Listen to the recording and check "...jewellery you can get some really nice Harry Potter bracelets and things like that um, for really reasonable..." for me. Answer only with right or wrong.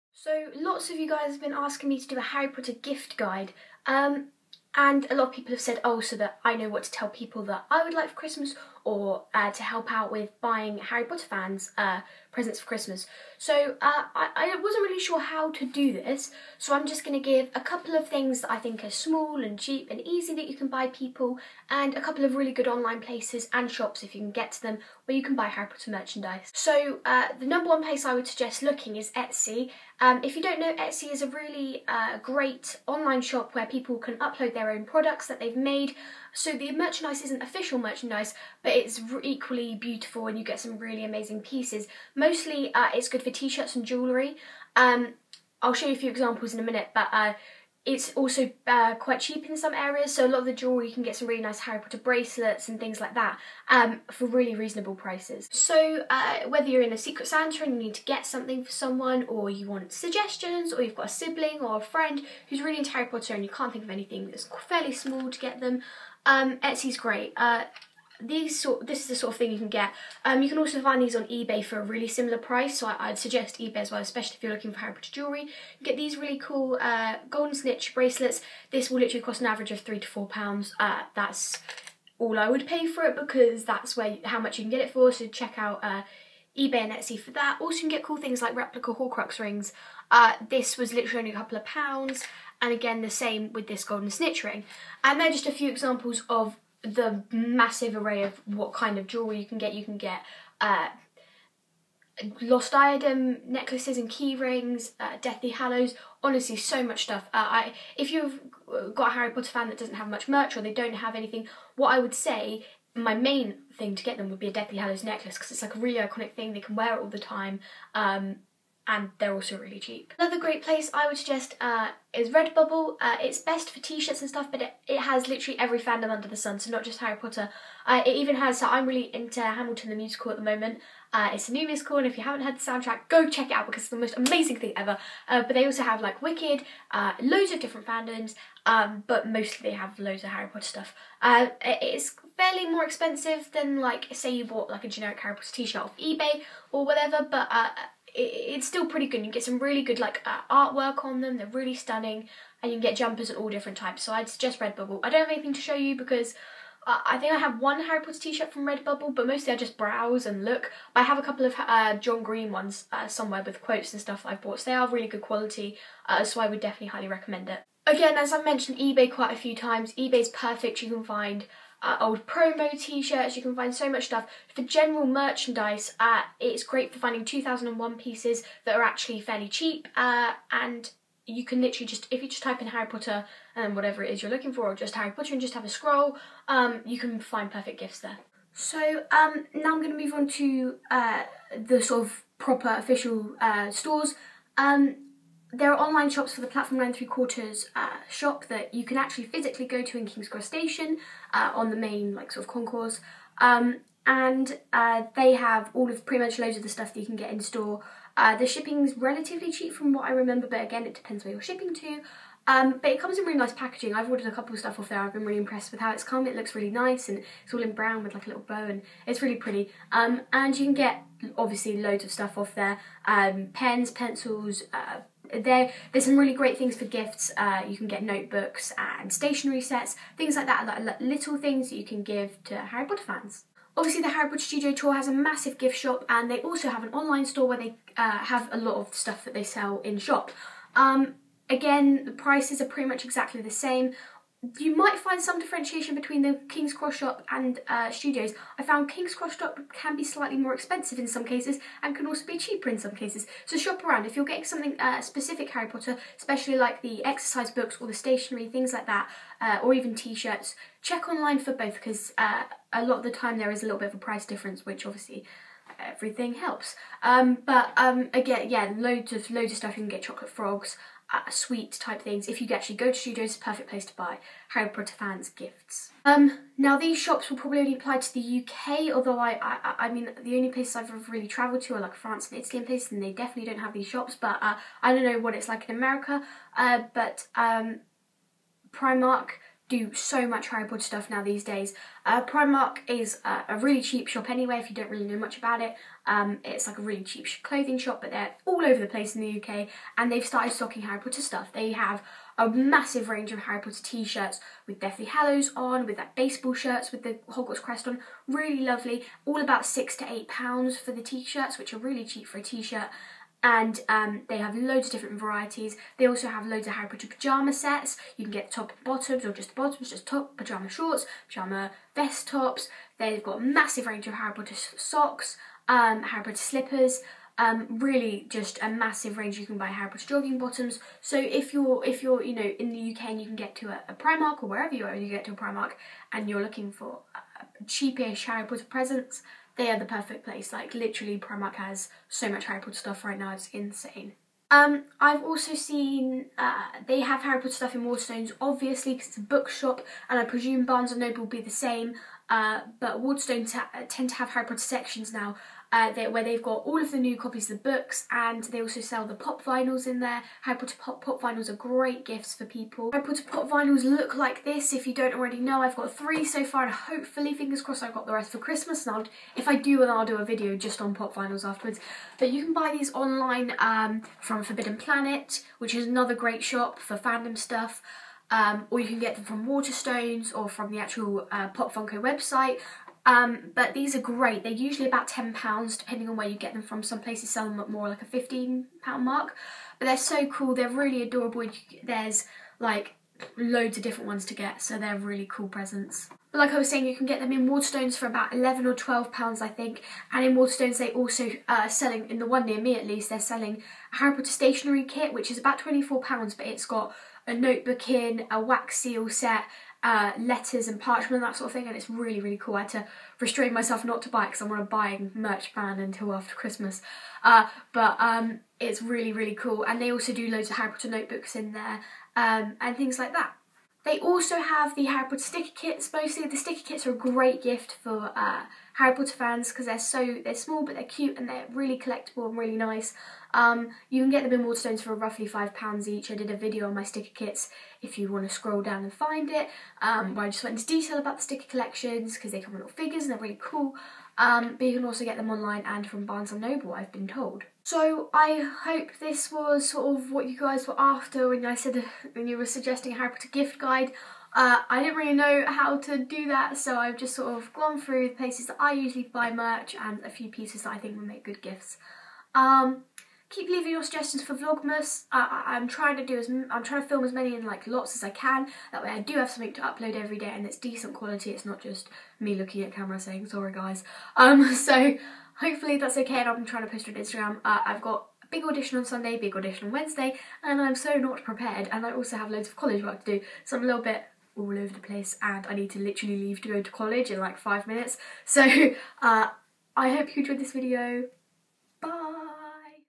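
right.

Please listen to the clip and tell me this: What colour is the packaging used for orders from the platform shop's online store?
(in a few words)
Brown.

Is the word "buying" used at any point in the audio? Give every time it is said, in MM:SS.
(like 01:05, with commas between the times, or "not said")
00:10, 06:54.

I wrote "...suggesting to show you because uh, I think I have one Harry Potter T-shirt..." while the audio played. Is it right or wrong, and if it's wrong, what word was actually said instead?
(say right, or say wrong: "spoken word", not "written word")
wrong: "anything", not "suggesting".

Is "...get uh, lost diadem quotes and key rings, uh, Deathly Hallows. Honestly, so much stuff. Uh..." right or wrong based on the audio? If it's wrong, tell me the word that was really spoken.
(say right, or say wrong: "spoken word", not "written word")
wrong: "necklaces", not "quotes".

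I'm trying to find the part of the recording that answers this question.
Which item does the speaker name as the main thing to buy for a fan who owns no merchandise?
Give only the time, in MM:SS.
01:54.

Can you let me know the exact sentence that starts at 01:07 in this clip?
Uh, these sort, this is the sort of thing you can get.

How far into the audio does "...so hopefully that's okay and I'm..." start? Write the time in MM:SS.
07:54.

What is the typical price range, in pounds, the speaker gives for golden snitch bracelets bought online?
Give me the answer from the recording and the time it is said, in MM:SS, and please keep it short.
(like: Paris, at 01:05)
3 to 4 pounds, at 01:19.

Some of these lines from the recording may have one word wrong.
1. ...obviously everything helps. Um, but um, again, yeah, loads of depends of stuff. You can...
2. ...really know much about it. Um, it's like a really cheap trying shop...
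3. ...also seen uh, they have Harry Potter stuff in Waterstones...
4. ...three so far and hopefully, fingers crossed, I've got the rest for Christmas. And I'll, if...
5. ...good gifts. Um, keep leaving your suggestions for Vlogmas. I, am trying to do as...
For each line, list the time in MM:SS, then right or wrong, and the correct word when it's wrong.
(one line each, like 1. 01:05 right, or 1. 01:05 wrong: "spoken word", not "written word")
1. 04:24 wrong: "loads", not "depends"
2. 04:54 wrong: "clothing", not "trying"
3. 05:45 right
4. 06:05 right
5. 07:41 right.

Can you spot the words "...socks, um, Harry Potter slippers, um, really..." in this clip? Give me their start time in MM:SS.
05:24.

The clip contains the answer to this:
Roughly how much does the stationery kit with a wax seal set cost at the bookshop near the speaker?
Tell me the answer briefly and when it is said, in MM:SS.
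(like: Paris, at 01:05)
24 pounds, at 06:45.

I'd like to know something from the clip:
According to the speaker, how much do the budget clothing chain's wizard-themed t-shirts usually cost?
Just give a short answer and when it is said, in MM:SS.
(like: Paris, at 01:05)
6 to 8 pounds, at 05:09.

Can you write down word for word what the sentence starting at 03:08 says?
So um, now I'm going to move on to uh, the sort of proper official uh, stores.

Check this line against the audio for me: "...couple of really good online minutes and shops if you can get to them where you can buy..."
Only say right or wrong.
wrong.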